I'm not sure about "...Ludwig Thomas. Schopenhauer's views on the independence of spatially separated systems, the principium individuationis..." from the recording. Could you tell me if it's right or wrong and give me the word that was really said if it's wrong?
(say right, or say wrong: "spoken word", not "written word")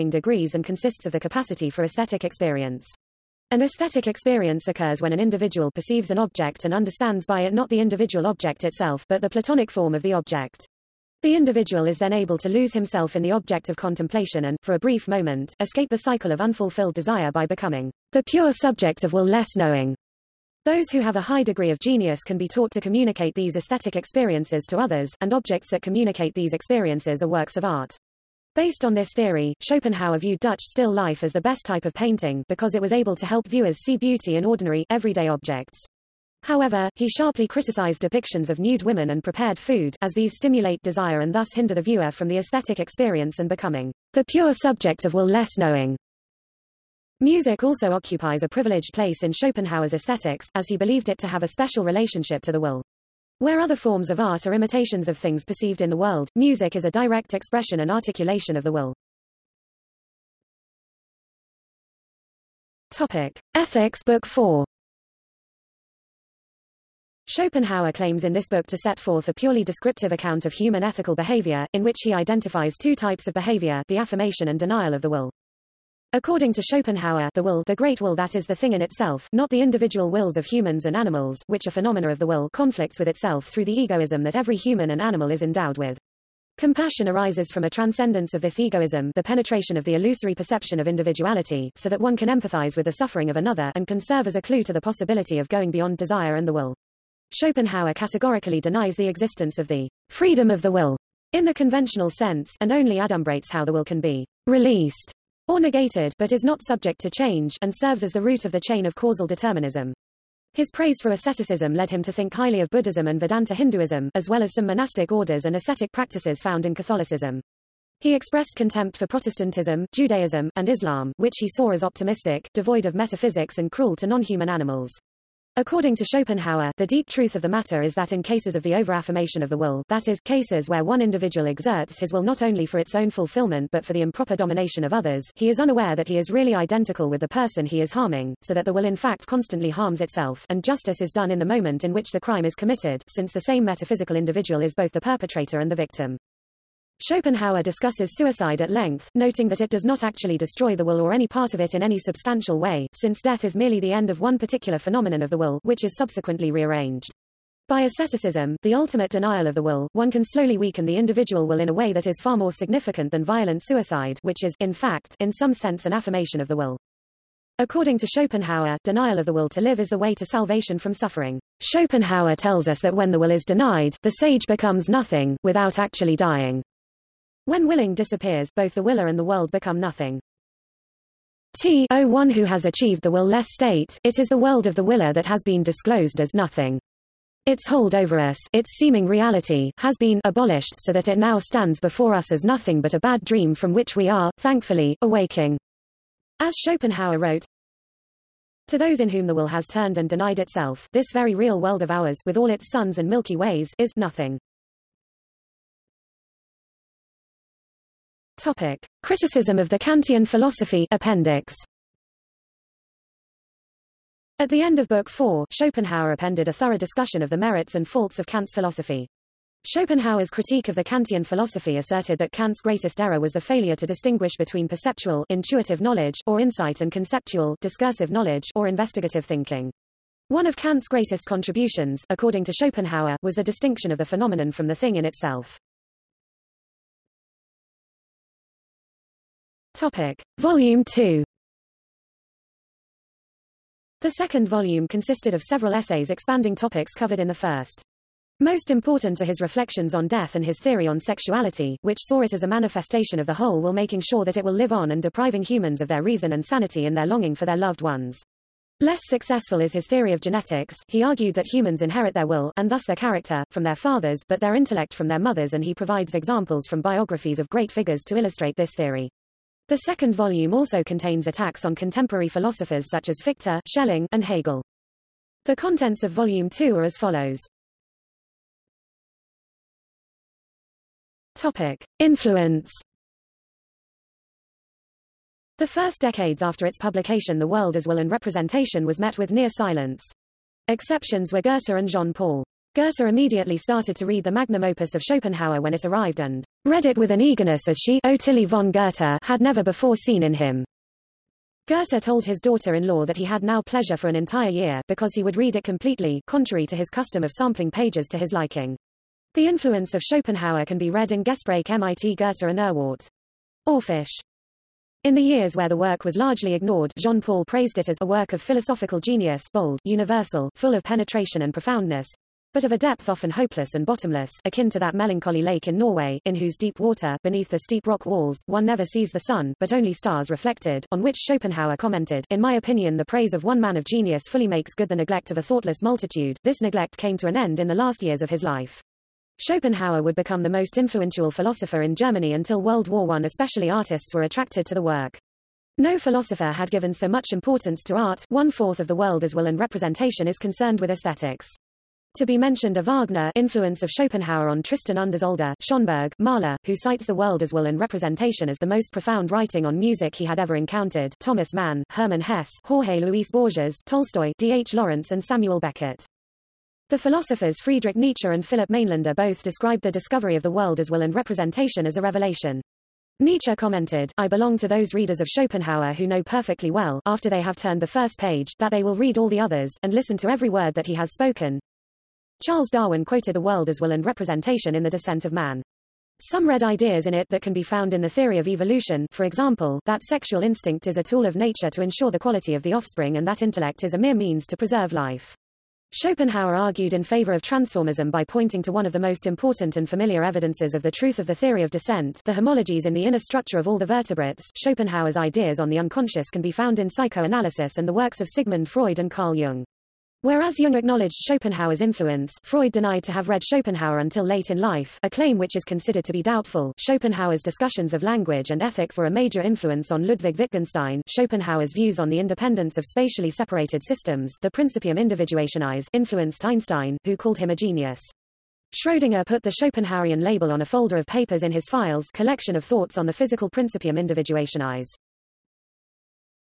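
wrong: "Wittgenstein", not "Thomas".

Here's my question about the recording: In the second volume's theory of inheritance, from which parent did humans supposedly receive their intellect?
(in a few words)
their mothers.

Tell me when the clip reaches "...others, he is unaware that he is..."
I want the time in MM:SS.
02:14.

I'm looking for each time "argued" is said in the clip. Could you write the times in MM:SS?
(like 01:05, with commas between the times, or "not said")
04:21, 06:36.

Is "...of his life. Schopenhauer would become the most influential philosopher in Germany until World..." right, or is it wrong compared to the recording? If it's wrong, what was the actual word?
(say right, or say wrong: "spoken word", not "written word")
right.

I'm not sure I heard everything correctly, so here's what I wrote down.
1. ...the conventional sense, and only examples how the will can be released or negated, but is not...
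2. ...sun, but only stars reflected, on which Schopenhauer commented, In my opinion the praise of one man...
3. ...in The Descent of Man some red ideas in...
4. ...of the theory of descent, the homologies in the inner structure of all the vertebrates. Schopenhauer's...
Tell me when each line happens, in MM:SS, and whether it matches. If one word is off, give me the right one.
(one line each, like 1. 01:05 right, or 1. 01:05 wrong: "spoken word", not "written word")
1. 01:41 wrong: "adumbrates", not "examples"
2. 05:29 right
3. 06:24 right
4. 06:41 right.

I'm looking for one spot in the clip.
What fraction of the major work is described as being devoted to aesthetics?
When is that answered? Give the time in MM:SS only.
05:48.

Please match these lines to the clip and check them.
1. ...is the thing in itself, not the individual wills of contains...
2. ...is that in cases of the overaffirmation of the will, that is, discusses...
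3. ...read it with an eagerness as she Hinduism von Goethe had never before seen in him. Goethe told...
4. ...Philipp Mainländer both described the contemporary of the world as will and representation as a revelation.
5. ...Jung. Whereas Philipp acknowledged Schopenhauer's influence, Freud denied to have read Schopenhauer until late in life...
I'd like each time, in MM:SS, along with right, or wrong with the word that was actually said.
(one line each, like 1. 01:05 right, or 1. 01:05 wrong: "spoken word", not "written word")
1. 01:18 wrong: "humans", not "contains"
2. 02:07 wrong: "cases", not "discusses"
3. 04:56 wrong: "Ottilie", not "Hinduism"
4. 06:08 wrong: "discovery", not "contemporary"
5. 06:49 wrong: "Jung", not "Philipp".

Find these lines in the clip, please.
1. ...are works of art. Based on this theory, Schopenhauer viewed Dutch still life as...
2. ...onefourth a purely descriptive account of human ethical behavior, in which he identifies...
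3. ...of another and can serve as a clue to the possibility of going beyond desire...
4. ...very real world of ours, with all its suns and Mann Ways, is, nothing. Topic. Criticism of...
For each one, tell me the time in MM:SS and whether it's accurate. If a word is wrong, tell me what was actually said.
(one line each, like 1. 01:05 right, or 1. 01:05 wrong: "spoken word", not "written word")
1. 00:27 right
2. 01:08 wrong: "forth", not "onefourth"
3. 01:33 right
4. 03:21 wrong: "Milky", not "Mann".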